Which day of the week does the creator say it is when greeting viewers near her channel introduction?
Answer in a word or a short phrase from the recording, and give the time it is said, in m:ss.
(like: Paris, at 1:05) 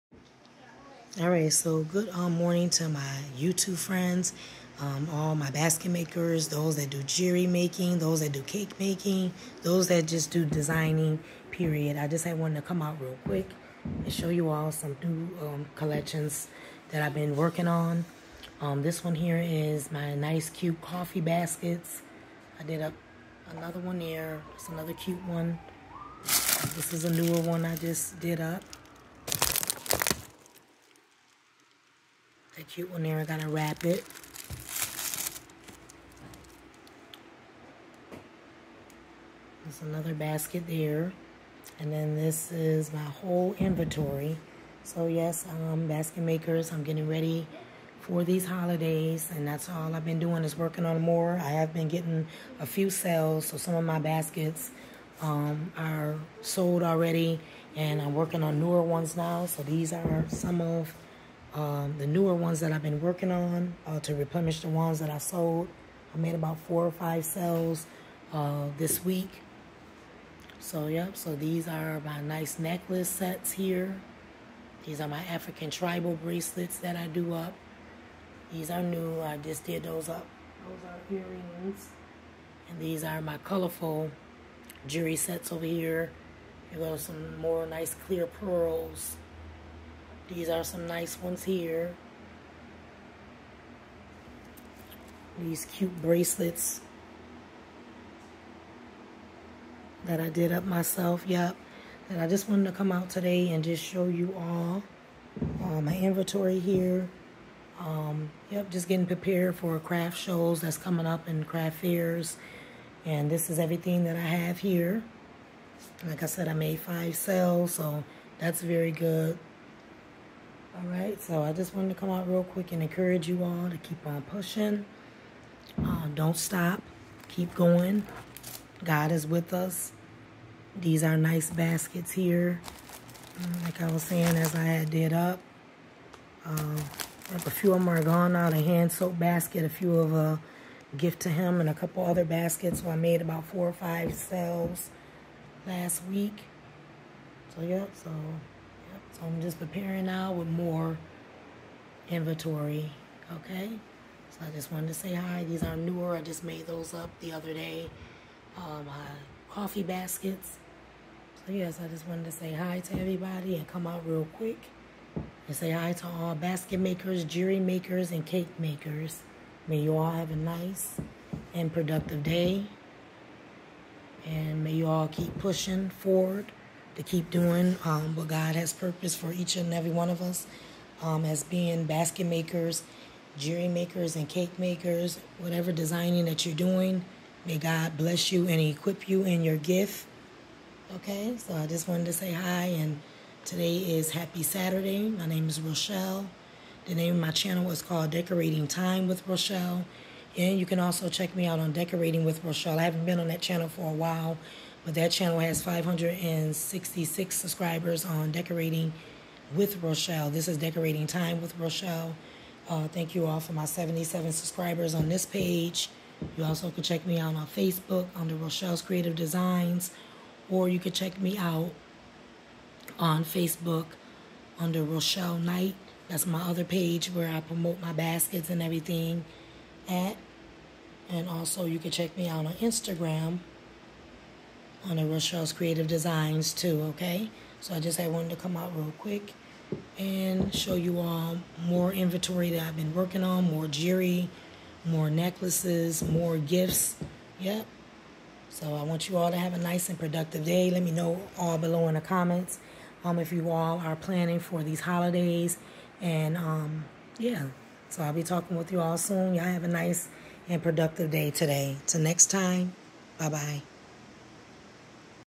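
Saturday, at 3:14.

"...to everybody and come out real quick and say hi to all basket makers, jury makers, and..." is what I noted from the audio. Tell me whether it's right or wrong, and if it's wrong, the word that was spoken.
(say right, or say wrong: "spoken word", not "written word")
right.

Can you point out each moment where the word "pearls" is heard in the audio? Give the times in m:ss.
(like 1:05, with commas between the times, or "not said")
1:28.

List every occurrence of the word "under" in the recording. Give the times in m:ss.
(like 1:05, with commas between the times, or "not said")
3:38, 3:44.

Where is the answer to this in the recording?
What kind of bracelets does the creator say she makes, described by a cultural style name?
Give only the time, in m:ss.
1:15.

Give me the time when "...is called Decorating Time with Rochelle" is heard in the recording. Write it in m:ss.
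3:17.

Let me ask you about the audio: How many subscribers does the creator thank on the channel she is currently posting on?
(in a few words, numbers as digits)
77.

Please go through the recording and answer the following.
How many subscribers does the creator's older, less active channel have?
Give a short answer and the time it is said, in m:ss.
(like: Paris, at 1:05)
566, at 3:25.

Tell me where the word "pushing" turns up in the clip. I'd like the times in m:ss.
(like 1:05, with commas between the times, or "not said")
2:04, 2:55.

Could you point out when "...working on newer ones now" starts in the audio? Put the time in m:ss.
0:58.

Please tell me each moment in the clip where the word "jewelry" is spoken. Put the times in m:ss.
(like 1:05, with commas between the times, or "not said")
0:07, 1:24, 3:03, 4:03.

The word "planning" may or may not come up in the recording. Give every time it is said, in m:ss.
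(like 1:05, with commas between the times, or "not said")
4:13.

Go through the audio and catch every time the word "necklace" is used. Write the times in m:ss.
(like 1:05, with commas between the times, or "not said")
1:12, 4:05.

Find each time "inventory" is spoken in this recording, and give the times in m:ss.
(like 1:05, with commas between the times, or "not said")
0:43, 1:45, 2:32, 4:01.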